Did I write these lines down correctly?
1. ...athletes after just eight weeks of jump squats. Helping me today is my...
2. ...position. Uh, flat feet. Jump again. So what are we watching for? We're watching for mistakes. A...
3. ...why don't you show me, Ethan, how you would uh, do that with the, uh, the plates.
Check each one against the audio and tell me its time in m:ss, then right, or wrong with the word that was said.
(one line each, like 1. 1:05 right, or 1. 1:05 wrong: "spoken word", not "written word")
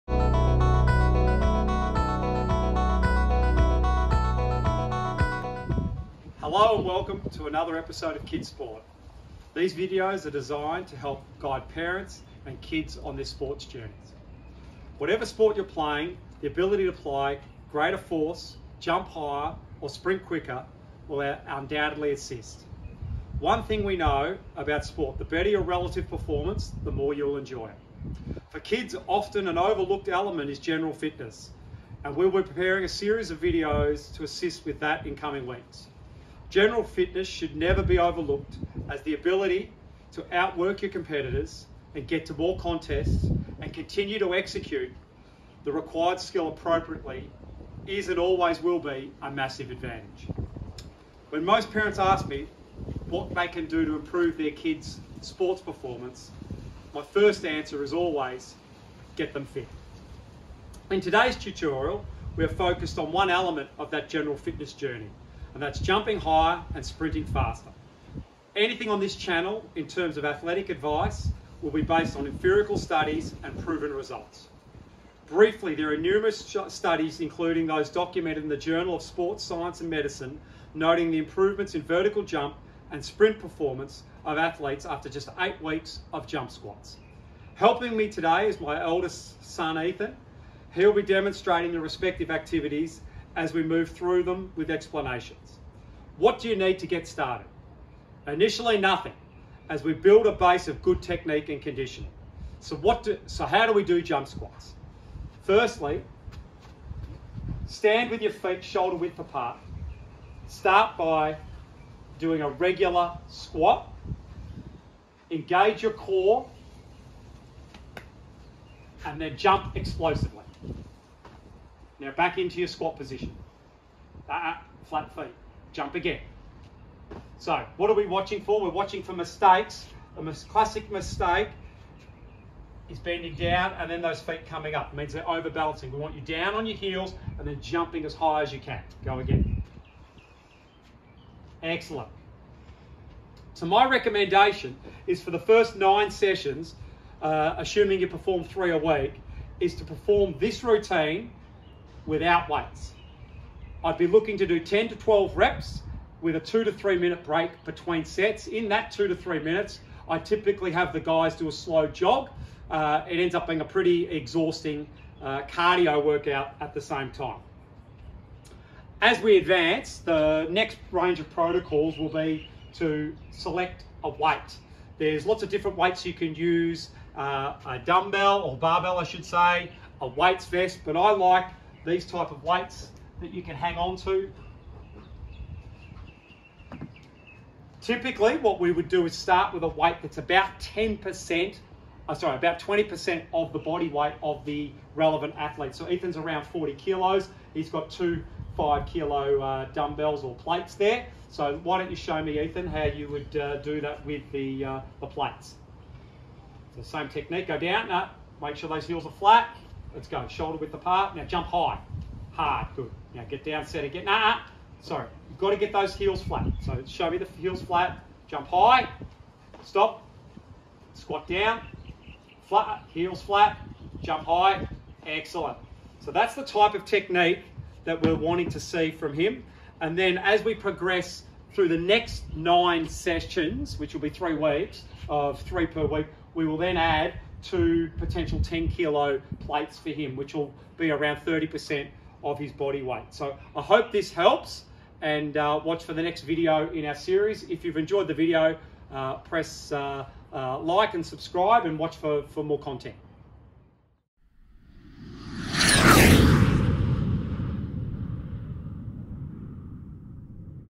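1. 1:24 right
2. 2:02 right
3. 3:21 right.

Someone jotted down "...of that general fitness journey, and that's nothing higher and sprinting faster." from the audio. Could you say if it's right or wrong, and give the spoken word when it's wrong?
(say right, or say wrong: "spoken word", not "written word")
wrong: "jumping", not "nothing".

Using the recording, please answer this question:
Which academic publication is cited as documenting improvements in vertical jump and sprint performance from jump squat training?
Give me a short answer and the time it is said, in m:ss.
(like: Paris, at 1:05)
Journal of Sports Science and Medicine, at 1:18.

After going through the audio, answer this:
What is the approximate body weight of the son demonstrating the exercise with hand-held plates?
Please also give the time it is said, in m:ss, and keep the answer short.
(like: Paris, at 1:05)
40 kilos, at 3:16.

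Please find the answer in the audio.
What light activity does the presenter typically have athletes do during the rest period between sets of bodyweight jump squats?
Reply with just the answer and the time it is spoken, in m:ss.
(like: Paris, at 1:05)
slow jog, at 2:41.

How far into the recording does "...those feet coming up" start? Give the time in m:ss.
2:14.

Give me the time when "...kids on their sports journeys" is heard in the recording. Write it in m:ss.
0:12.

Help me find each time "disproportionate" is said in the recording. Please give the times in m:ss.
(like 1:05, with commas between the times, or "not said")
not said.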